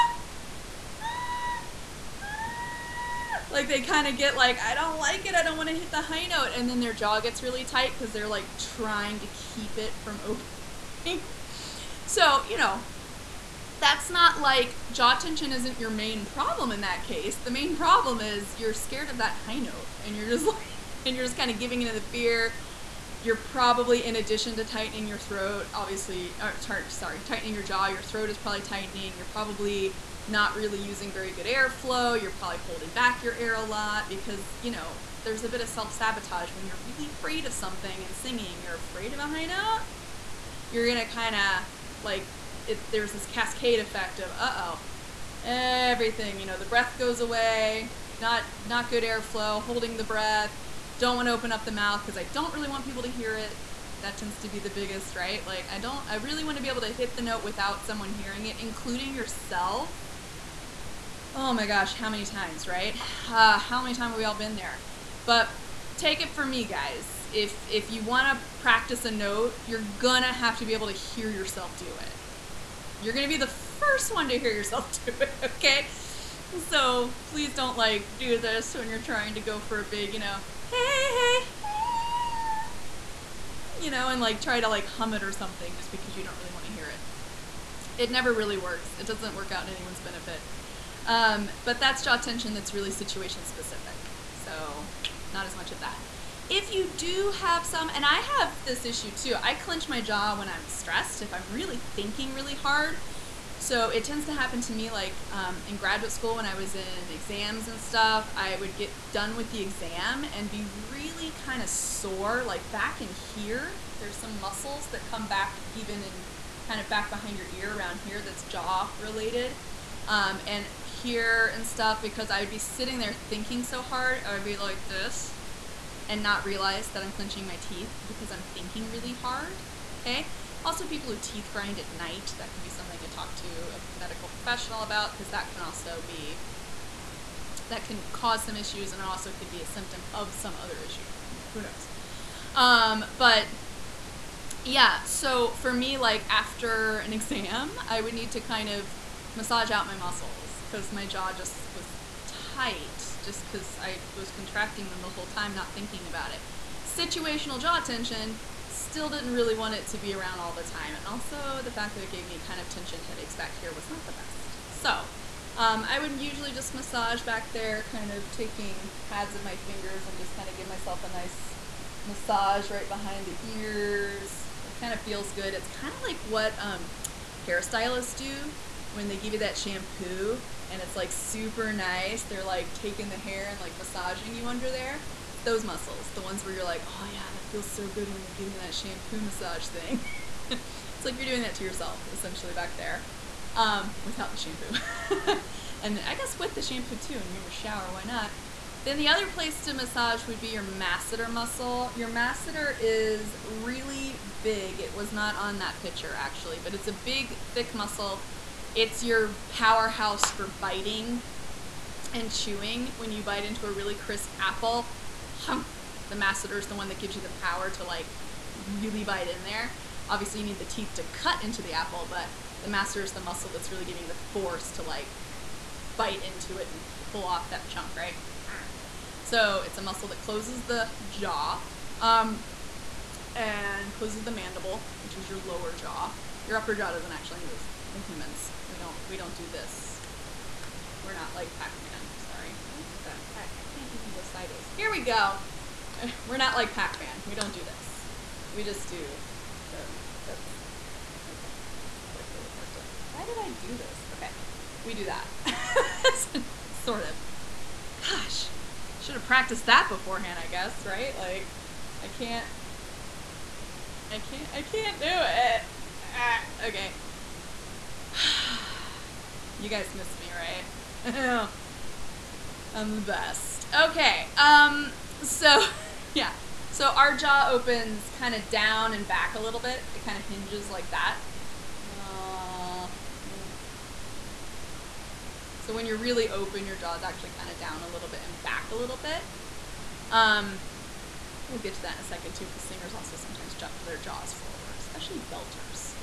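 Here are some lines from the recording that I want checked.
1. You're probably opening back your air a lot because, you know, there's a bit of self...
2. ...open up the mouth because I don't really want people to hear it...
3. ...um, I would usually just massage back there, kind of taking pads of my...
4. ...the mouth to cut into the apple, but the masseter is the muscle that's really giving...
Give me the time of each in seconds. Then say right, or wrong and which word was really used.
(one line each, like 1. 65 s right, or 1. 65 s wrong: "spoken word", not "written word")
1. 32 s wrong: "holding", not "opening"
2. 51 s right
3. 165 s right
4. 220 s wrong: "teeth", not "mouth".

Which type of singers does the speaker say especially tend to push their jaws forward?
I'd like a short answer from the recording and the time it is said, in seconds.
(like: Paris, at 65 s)
belters, at 295 s.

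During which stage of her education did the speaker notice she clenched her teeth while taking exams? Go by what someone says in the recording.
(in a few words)
graduate school.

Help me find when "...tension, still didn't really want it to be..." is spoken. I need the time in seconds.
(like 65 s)
157 s.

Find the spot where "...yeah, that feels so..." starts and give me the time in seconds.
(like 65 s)
187 s.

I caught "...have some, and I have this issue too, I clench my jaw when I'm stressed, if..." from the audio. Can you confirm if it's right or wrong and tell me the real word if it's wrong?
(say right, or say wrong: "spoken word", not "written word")
right.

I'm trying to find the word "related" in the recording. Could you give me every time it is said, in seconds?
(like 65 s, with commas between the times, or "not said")
118 s.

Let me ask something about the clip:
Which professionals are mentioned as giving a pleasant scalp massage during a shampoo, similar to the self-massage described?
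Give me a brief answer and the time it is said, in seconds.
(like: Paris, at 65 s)
hairstylists, at 177 s.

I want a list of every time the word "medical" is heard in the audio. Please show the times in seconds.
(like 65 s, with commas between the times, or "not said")
133 s.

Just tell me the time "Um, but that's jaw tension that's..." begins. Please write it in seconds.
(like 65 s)
91 s.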